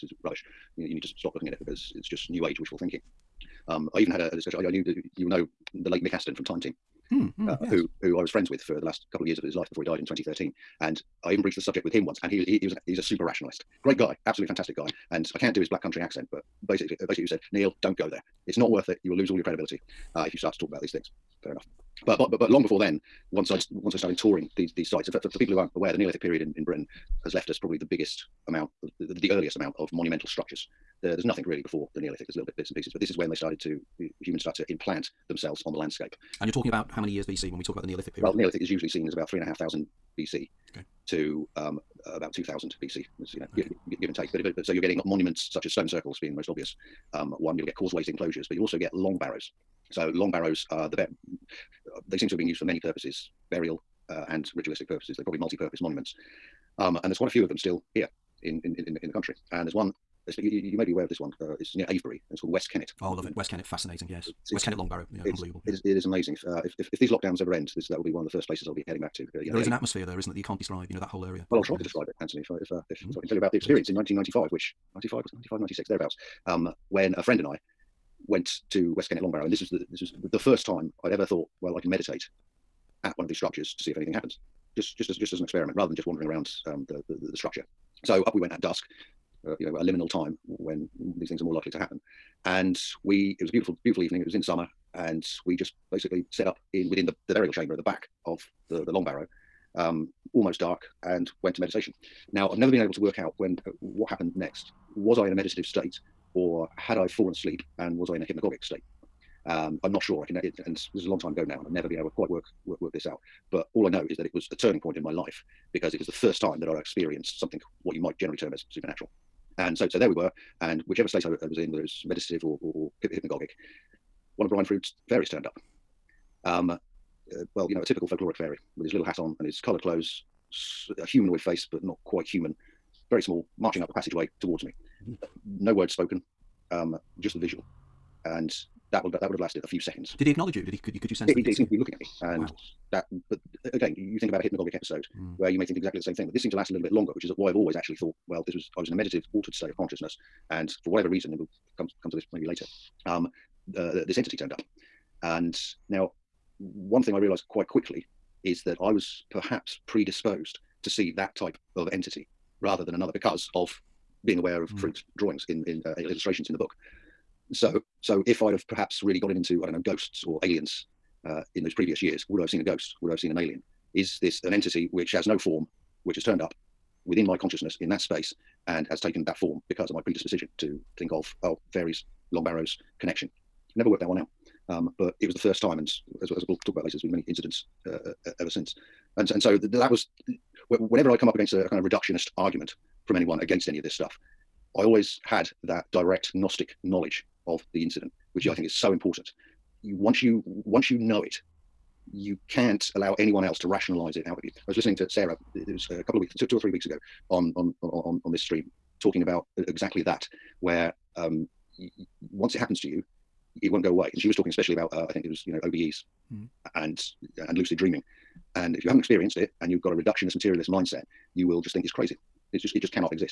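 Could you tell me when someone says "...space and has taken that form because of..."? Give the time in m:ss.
2:57.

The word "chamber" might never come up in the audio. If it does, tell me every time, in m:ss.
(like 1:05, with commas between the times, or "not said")
1:37.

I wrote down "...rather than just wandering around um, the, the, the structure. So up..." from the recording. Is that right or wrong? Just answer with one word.
right.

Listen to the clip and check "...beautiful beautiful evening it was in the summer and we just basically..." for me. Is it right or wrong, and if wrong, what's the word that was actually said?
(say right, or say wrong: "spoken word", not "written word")
right.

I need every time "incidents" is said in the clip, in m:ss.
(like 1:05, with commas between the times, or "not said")
3:07, 3:17.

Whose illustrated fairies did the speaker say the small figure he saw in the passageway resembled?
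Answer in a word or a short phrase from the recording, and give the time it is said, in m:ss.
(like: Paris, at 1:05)
Brian Froud, at 2:04.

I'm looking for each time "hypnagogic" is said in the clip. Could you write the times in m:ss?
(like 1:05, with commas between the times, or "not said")
1:48, 2:03, 2:24.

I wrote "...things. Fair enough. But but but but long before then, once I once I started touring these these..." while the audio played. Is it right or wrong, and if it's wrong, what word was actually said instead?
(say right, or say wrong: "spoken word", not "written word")
right.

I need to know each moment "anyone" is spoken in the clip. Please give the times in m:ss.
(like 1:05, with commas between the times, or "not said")
3:13, 3:23.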